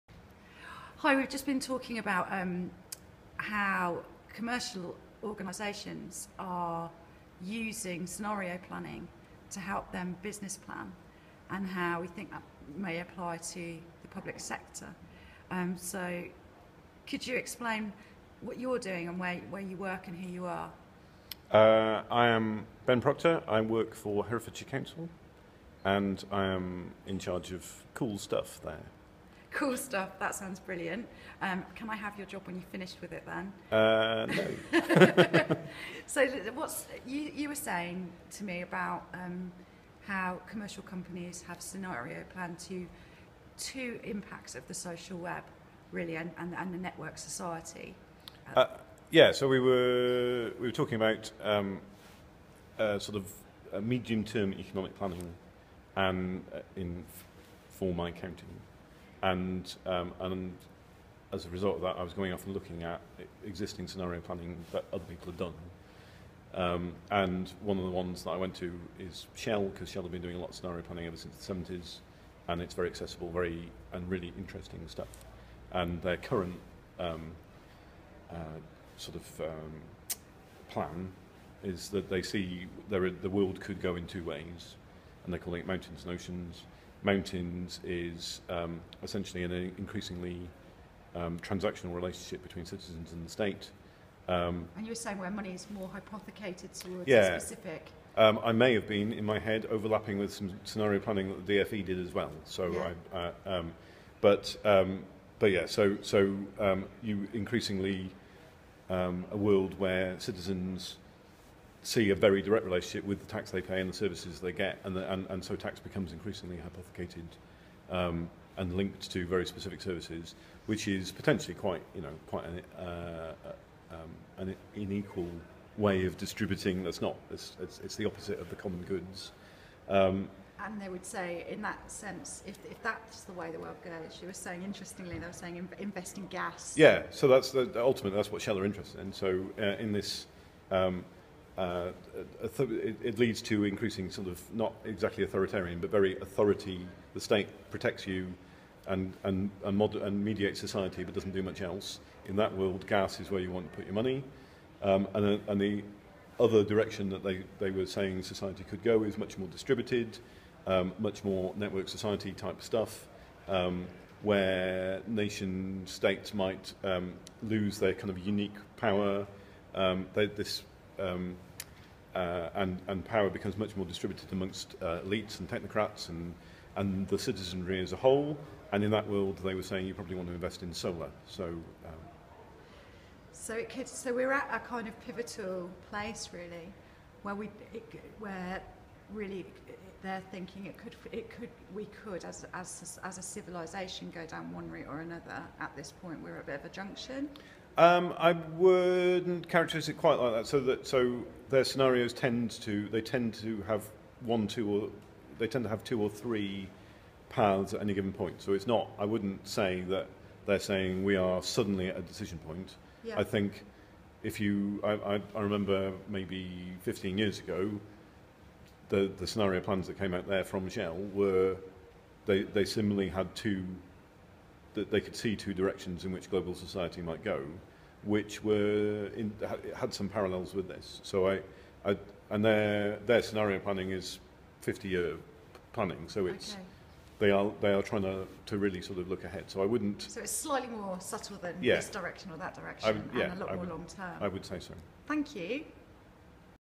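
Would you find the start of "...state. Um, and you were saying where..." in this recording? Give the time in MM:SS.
01:33.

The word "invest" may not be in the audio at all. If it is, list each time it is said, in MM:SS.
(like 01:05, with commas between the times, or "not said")
02:15, 03:00.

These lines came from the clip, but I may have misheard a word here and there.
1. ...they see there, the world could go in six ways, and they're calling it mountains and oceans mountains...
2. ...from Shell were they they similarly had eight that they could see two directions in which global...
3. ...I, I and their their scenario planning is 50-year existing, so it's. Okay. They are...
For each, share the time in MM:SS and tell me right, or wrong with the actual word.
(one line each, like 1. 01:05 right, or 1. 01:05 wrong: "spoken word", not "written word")
1. 01:22 wrong: "two", not "six"
2. 03:40 wrong: "two", not "eight"
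3. 03:51 wrong: "planning", not "existing".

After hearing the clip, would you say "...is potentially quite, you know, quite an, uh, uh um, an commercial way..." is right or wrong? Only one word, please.
wrong.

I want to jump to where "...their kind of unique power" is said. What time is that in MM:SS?
02:47.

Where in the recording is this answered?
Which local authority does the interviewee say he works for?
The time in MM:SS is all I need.
00:24.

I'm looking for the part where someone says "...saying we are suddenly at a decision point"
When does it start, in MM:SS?
03:30.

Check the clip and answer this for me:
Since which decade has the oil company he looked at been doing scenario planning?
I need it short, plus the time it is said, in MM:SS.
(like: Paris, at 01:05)
The 70s, at 01:11.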